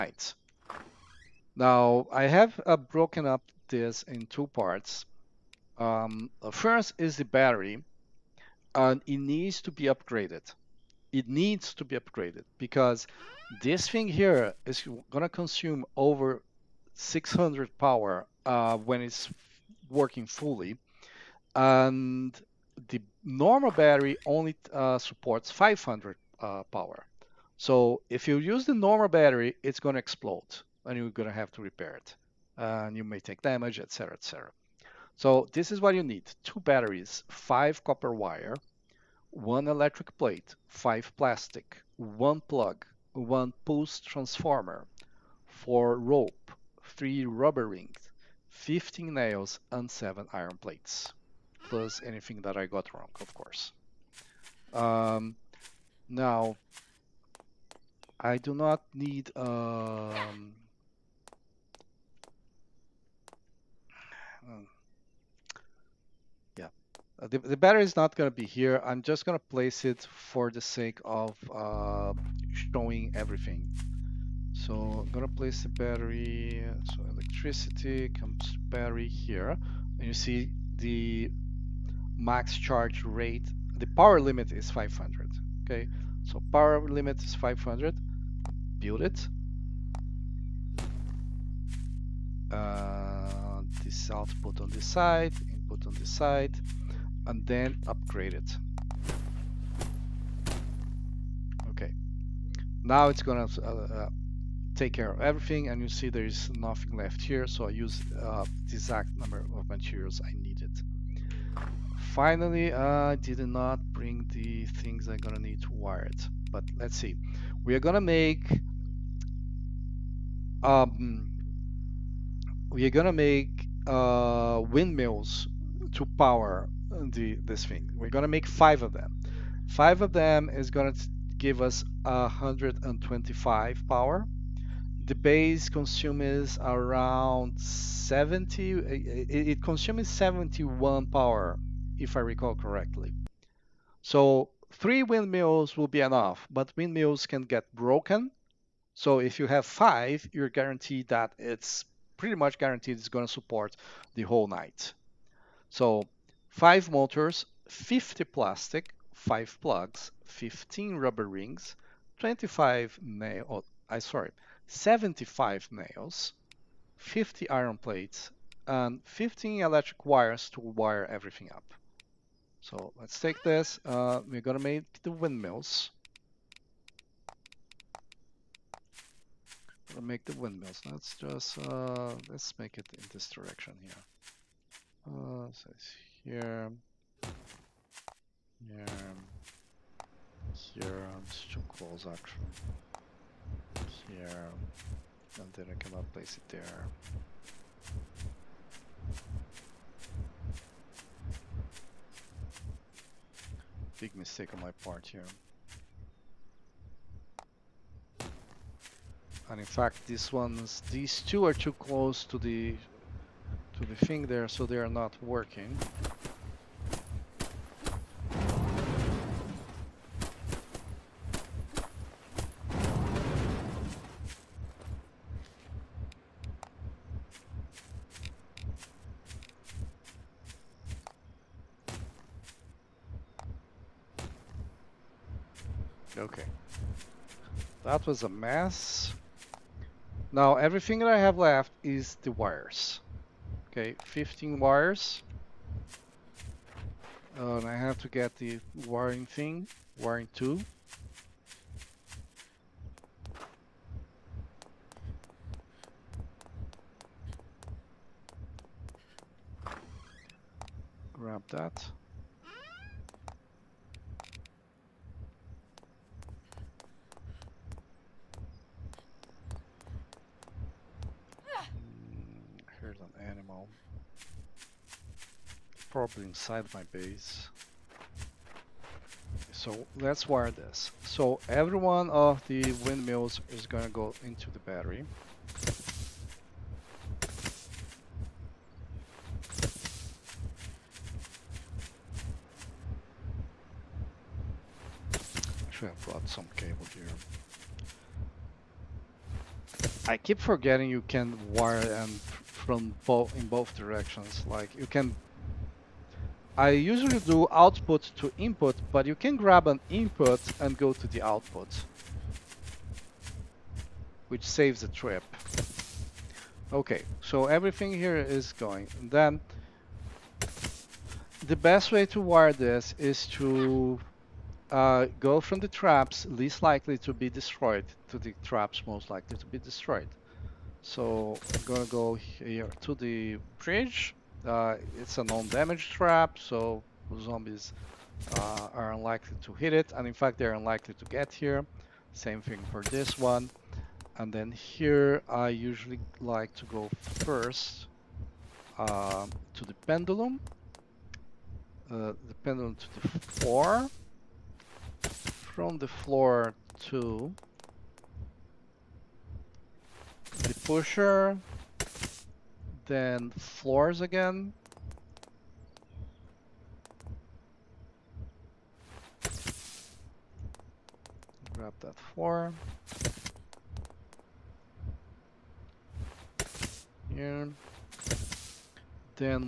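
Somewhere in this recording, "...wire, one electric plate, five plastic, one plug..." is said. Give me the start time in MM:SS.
00:38.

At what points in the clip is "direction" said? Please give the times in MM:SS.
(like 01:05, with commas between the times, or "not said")
03:03, 05:03.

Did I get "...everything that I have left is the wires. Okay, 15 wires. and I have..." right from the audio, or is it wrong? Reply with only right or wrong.
right.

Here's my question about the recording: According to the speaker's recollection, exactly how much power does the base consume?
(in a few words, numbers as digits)
71.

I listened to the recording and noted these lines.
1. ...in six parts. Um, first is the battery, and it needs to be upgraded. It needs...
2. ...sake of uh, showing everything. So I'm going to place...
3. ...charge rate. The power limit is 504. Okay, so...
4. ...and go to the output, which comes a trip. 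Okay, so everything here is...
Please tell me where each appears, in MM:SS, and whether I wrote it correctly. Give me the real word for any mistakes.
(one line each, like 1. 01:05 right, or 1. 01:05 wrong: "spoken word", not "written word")
1. 00:04 wrong: "two", not "six"
2. 01:10 right
3. 01:22 wrong: "500", not "504"
4. 05:10 wrong: "saves", not "comes".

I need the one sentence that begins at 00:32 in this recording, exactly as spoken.
and you may take damage, etc., etc.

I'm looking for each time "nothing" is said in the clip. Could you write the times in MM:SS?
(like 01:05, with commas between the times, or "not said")
01:46.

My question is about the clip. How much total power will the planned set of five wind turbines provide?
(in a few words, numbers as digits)
125.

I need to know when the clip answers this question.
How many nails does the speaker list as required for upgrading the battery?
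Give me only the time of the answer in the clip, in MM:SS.
00:48.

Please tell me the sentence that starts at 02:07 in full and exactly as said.
We're going to make five of them.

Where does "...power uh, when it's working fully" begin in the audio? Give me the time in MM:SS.
00:17.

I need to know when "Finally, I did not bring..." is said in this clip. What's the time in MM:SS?
01:51.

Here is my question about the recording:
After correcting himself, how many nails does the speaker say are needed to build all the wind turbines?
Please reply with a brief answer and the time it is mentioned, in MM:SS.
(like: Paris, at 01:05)
75, at 02:44.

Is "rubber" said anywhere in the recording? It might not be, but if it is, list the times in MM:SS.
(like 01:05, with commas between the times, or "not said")
00:47, 02:40.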